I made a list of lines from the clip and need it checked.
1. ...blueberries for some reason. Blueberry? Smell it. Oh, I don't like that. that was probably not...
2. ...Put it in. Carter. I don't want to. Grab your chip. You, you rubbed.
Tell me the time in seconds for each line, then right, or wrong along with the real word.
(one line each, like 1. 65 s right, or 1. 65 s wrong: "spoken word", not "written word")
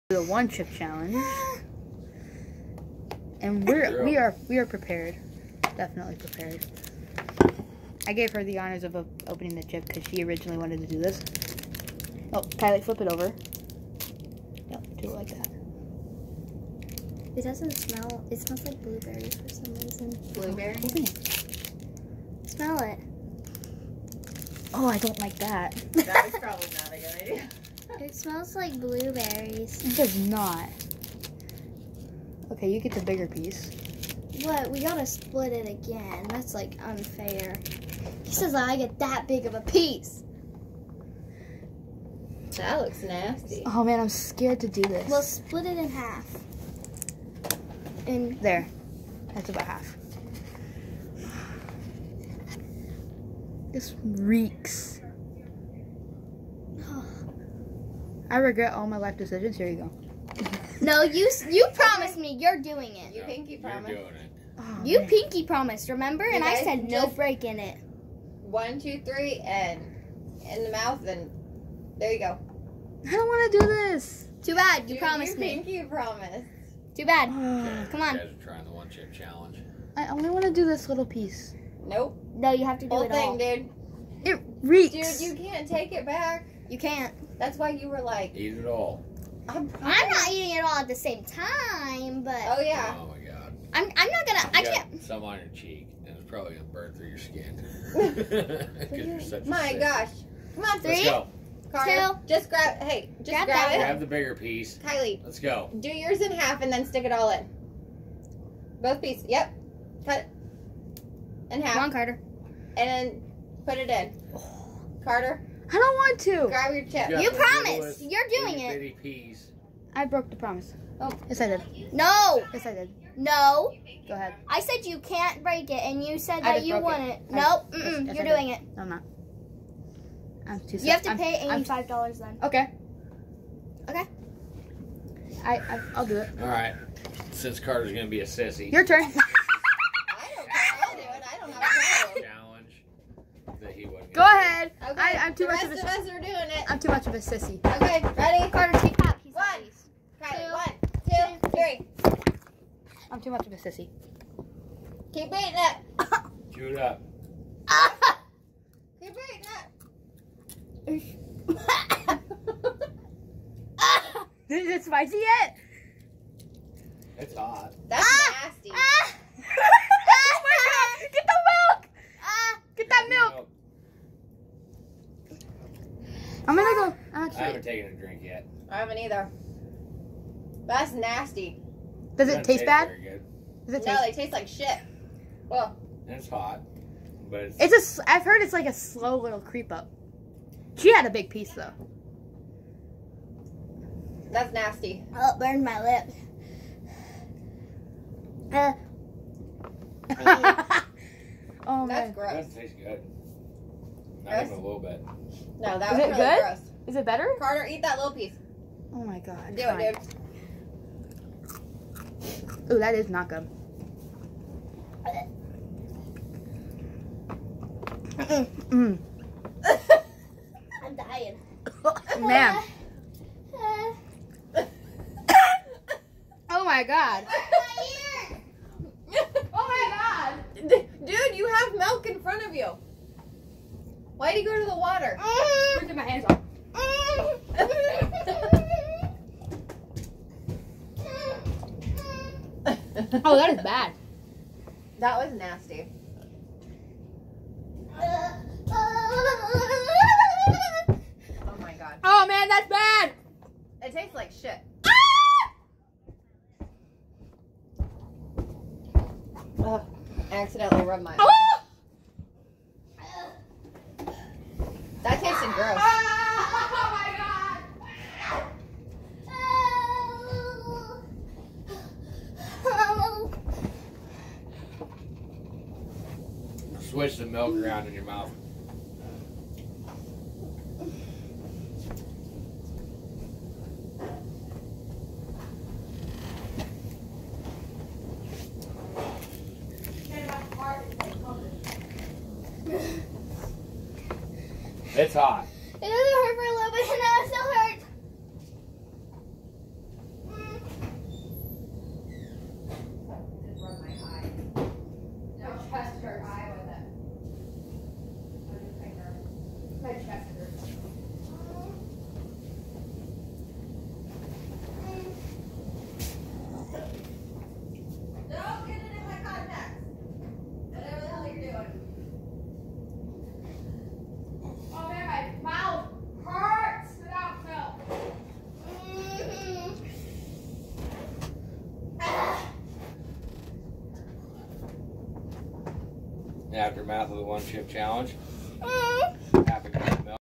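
1. 18 s right
2. 113 s wrong: "promised", not "rubbed".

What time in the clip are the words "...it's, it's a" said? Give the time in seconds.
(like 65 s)
187 s.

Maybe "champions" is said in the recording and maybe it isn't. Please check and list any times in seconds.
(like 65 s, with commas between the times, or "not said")
not said.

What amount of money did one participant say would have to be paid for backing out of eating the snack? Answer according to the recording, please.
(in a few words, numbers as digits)
$85.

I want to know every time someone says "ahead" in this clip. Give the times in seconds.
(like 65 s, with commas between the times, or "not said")
124 s, 144 s.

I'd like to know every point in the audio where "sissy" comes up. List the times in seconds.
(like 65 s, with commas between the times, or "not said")
138 s, 147 s, 153 s.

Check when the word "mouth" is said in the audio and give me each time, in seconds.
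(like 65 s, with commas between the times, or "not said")
70 s, 278 s.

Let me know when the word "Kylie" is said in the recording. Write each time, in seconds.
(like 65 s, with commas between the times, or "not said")
12 s, 104 s.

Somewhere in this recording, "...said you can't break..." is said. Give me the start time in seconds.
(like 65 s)
124 s.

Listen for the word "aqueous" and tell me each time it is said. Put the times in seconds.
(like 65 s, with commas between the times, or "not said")
not said.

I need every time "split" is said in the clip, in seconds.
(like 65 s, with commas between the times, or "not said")
35 s, 45 s.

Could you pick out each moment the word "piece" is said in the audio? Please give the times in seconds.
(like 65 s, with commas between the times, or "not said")
33 s, 39 s, 81 s, 104 s, 109 s, 191 s, 208 s.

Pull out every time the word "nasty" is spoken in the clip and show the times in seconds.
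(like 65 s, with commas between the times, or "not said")
43 s, 168 s, 180 s, 194 s, 245 s.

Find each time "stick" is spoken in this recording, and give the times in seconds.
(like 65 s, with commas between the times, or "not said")
106 s.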